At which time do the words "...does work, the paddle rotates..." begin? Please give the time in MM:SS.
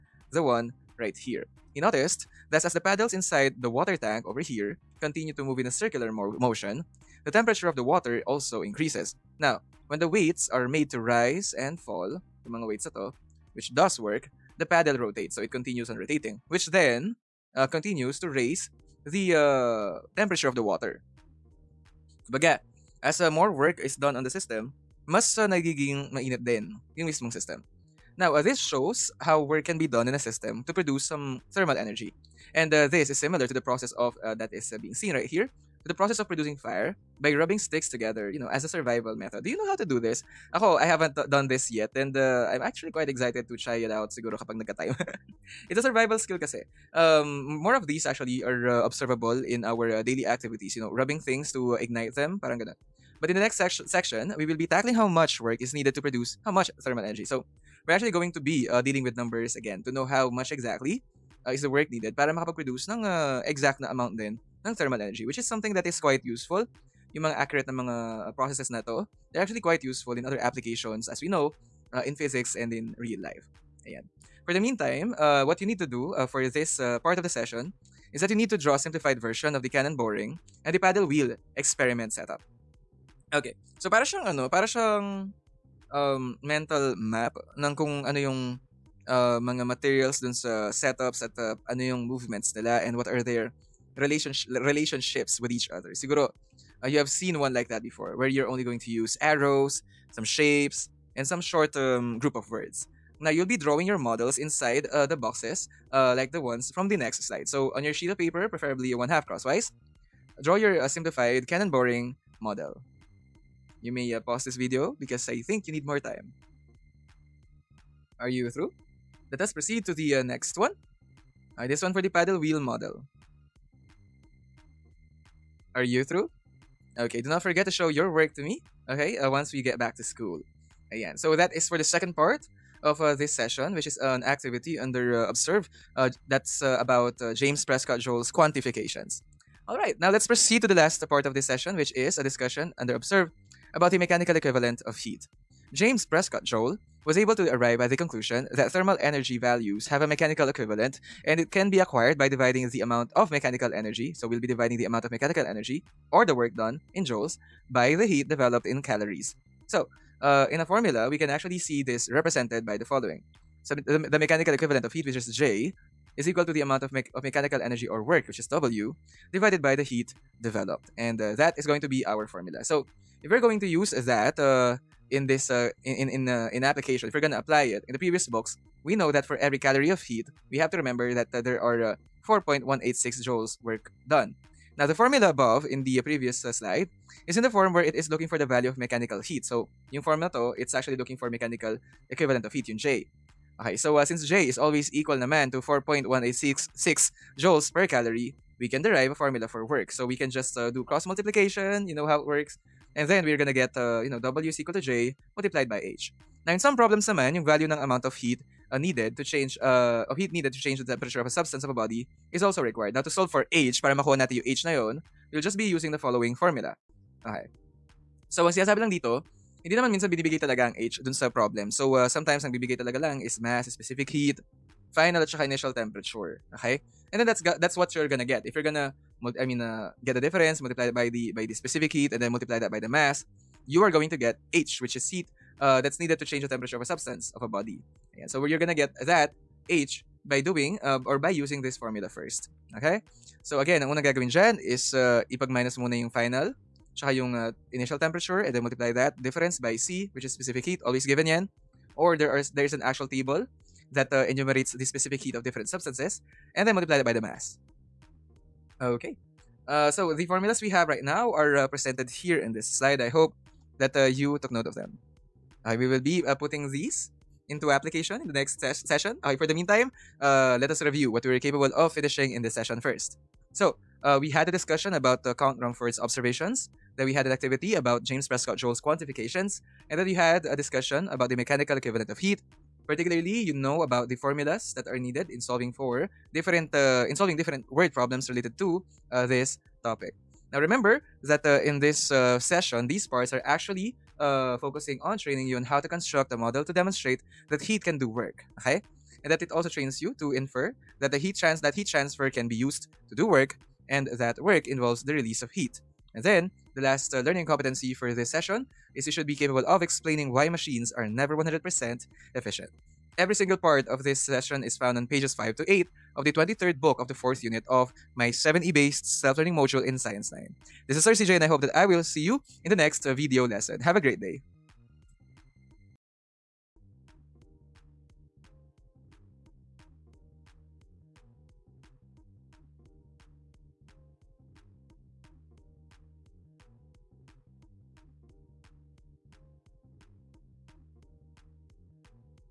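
00:13.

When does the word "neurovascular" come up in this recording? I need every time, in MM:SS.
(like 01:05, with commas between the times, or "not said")
not said.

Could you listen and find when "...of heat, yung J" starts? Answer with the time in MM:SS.
03:12.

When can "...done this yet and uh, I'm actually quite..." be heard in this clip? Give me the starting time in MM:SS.
00:41.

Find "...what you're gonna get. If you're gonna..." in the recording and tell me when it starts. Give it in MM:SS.
03:47.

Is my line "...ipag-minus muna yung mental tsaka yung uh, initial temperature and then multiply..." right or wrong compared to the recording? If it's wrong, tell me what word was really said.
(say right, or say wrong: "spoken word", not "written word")
wrong: "final", not "mental".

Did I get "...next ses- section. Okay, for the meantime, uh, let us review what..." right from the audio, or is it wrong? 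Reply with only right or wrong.
wrong.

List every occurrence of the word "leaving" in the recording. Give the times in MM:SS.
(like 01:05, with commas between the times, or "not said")
not said.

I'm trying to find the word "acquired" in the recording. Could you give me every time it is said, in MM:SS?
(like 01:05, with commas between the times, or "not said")
02:31.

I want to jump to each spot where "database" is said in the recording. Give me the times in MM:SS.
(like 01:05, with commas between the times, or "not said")
not said.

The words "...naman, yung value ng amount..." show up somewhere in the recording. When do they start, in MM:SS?
03:27.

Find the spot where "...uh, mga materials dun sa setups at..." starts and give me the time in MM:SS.
01:29.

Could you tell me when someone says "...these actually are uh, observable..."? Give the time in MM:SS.
00:47.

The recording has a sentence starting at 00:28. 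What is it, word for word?
Now, uh, this shows how work can be done in a system to produce some thermal energy.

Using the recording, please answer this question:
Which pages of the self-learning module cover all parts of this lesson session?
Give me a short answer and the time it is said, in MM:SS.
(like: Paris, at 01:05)
Pages 5 to 8, at 05:15.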